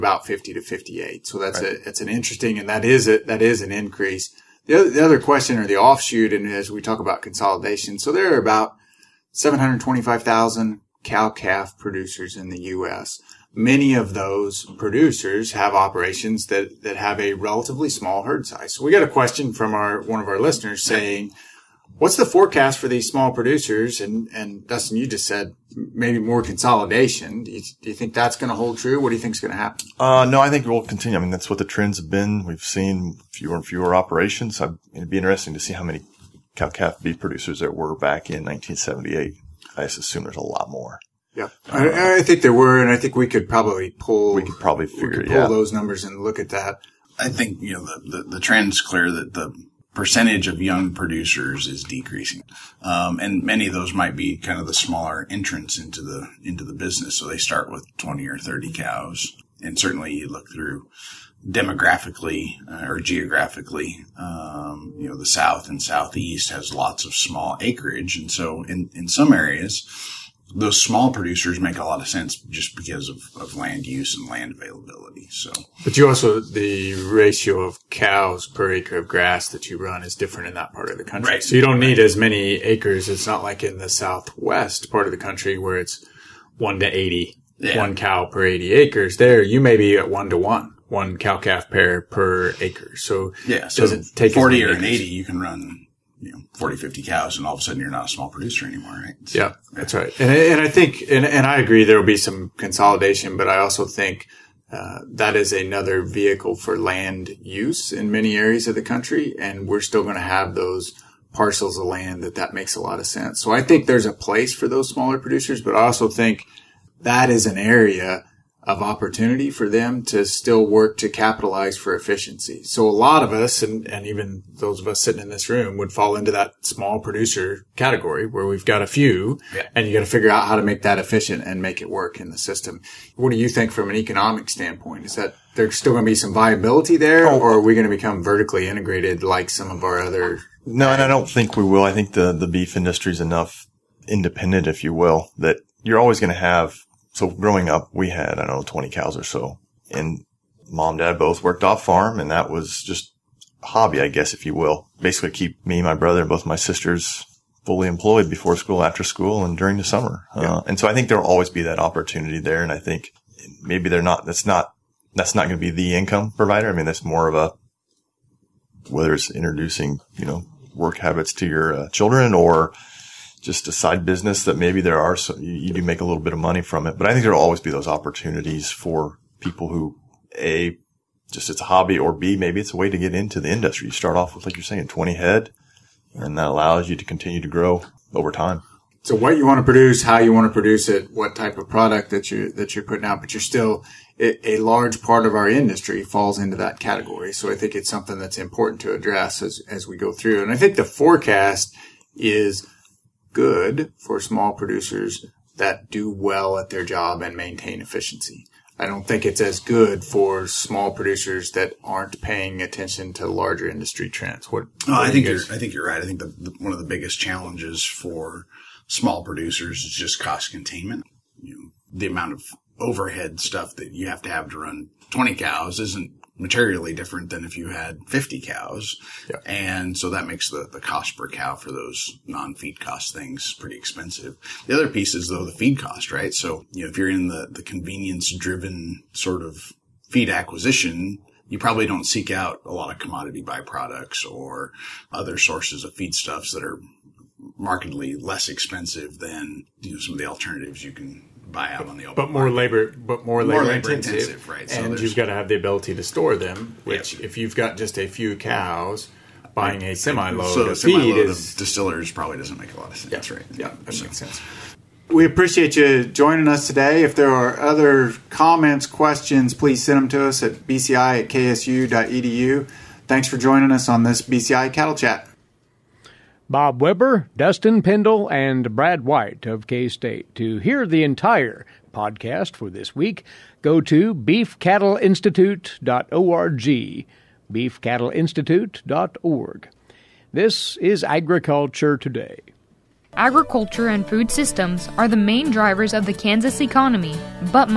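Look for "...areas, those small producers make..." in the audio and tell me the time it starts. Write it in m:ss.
1:09.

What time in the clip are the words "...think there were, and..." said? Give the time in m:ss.
0:42.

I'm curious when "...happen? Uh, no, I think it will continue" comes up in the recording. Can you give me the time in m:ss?
0:29.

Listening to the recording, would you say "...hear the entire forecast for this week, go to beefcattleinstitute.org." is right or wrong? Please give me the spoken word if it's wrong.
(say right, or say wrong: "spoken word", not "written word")
wrong: "podcast", not "forecast".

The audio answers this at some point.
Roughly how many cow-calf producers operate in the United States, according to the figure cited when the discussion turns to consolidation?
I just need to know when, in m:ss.
0:09.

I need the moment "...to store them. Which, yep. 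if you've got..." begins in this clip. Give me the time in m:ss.
4:15.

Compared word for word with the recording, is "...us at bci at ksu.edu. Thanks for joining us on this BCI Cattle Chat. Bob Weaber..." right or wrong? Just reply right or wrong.
right.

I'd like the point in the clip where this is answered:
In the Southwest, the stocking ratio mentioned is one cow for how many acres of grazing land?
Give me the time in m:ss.
1:27.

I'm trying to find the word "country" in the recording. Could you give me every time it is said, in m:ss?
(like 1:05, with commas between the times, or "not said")
1:21, 1:25, 1:48.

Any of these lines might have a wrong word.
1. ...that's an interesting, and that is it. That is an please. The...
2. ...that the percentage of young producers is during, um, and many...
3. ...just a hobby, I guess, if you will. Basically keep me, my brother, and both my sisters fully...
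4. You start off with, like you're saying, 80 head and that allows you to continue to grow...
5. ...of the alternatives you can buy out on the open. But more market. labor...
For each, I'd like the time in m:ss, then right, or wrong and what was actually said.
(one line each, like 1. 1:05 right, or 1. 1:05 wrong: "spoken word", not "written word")
1. 0:01 wrong: "increase", not "please"
2. 0:49 wrong: "decreasing", not "during"
3. 2:32 right
4. 3:03 wrong: "20", not "80"
5. 4:10 right.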